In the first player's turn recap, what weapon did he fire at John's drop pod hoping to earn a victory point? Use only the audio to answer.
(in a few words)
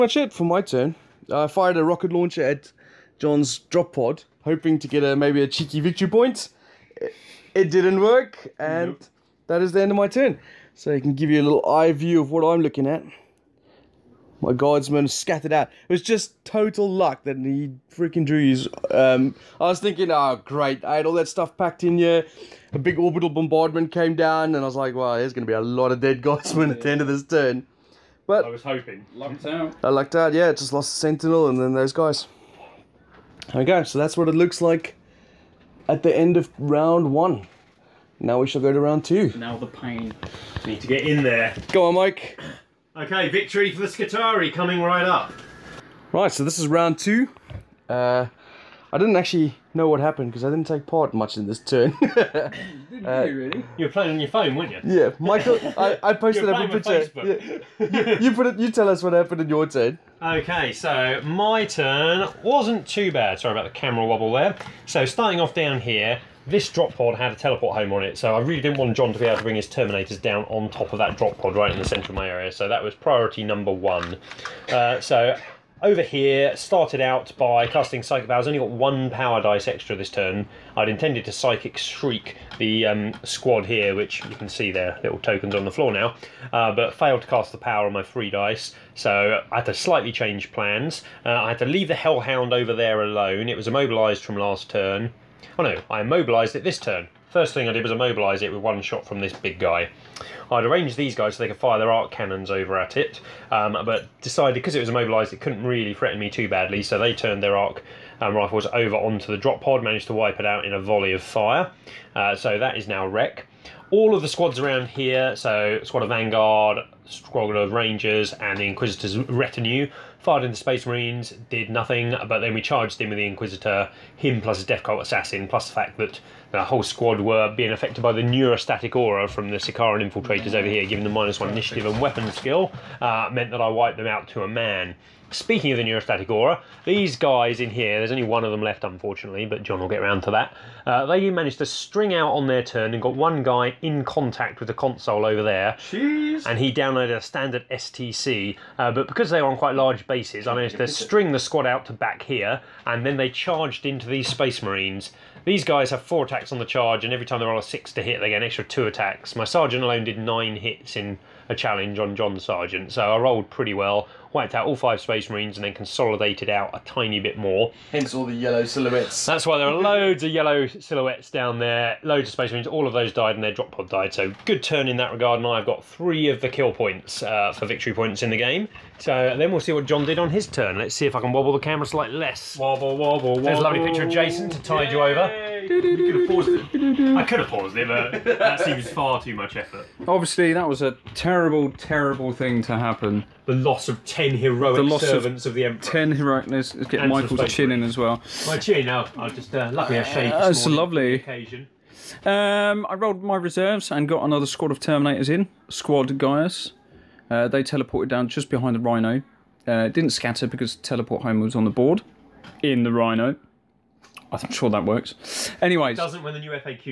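Rocket launcher.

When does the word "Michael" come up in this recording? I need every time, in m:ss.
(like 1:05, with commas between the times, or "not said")
0:55, 3:17.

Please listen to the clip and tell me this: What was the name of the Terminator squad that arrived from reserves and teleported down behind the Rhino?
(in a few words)
Squad Gaius.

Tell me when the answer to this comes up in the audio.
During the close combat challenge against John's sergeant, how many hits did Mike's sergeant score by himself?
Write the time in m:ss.
2:40.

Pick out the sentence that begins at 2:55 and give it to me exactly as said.
And I've got three of the kill points uh, for victory points in the game.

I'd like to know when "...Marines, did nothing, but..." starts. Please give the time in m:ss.
2:00.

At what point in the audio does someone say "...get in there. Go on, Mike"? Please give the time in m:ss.
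0:40.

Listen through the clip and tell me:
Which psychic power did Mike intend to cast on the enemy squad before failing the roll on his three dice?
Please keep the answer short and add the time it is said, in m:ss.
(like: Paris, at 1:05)
Psychic Shriek, at 1:21.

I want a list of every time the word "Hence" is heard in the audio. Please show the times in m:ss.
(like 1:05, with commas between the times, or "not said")
2:47.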